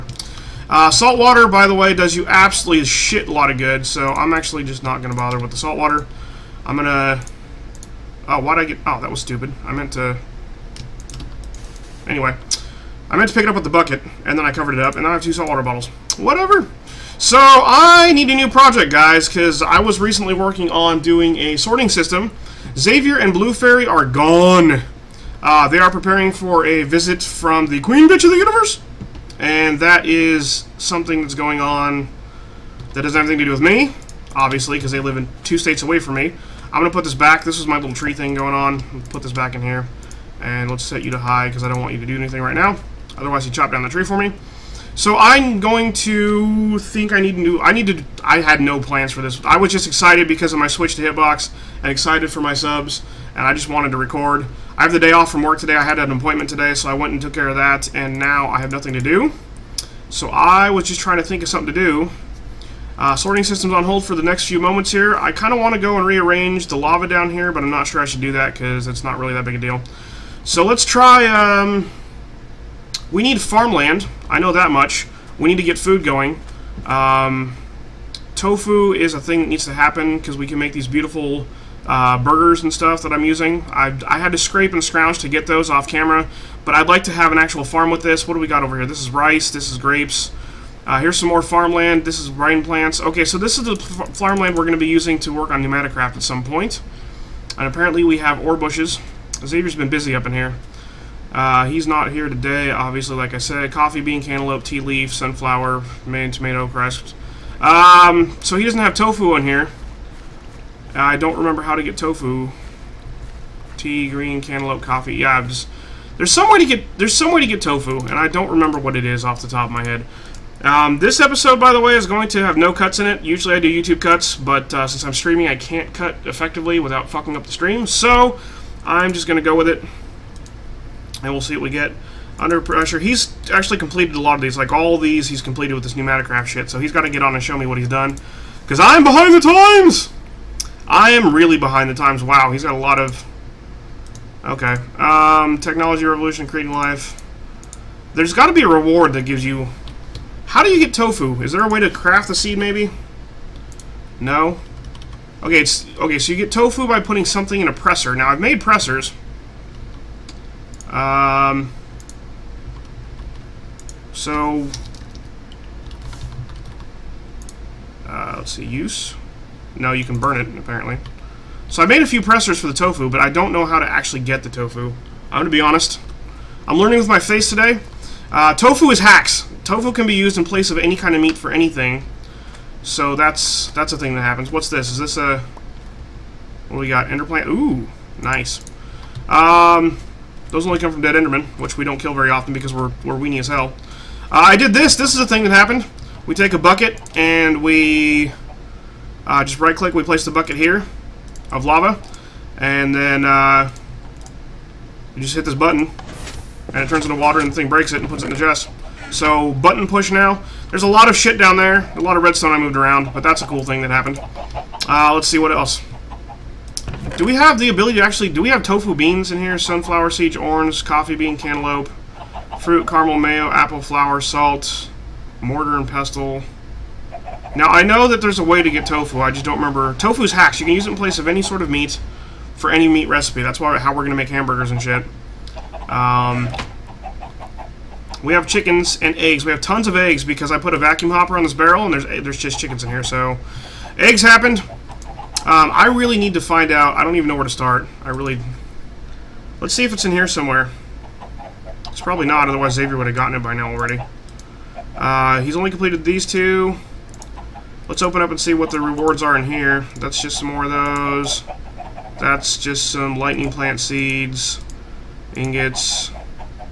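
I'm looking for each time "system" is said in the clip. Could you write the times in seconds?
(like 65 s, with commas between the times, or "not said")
21 s, 63 s.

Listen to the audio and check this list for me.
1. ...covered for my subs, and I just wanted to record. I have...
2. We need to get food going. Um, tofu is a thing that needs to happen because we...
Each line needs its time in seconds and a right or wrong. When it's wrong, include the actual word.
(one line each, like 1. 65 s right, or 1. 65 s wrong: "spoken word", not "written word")
1. 51 s wrong: "excited", not "covered"
2. 75 s right.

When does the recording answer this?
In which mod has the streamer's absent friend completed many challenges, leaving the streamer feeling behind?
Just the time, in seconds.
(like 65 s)
135 s.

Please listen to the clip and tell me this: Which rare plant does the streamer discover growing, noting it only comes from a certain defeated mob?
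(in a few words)
Enderplant.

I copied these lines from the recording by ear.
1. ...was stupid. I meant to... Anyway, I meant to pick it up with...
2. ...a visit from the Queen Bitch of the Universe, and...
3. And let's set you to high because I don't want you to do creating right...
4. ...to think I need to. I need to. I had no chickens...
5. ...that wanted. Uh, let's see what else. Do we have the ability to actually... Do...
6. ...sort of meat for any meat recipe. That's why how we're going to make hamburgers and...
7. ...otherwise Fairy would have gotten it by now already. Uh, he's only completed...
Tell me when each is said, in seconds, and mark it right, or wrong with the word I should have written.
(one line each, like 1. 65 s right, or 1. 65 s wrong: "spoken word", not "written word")
1. 9 s right
2. 26 s right
3. 40 s wrong: "anything", not "creating"
4. 45 s wrong: "plans", not "chickens"
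5. 213 s wrong: "happened", not "wanted"
6. 231 s right
7. 252 s wrong: "Xavier", not "Fairy".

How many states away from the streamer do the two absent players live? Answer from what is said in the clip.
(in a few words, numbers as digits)
2.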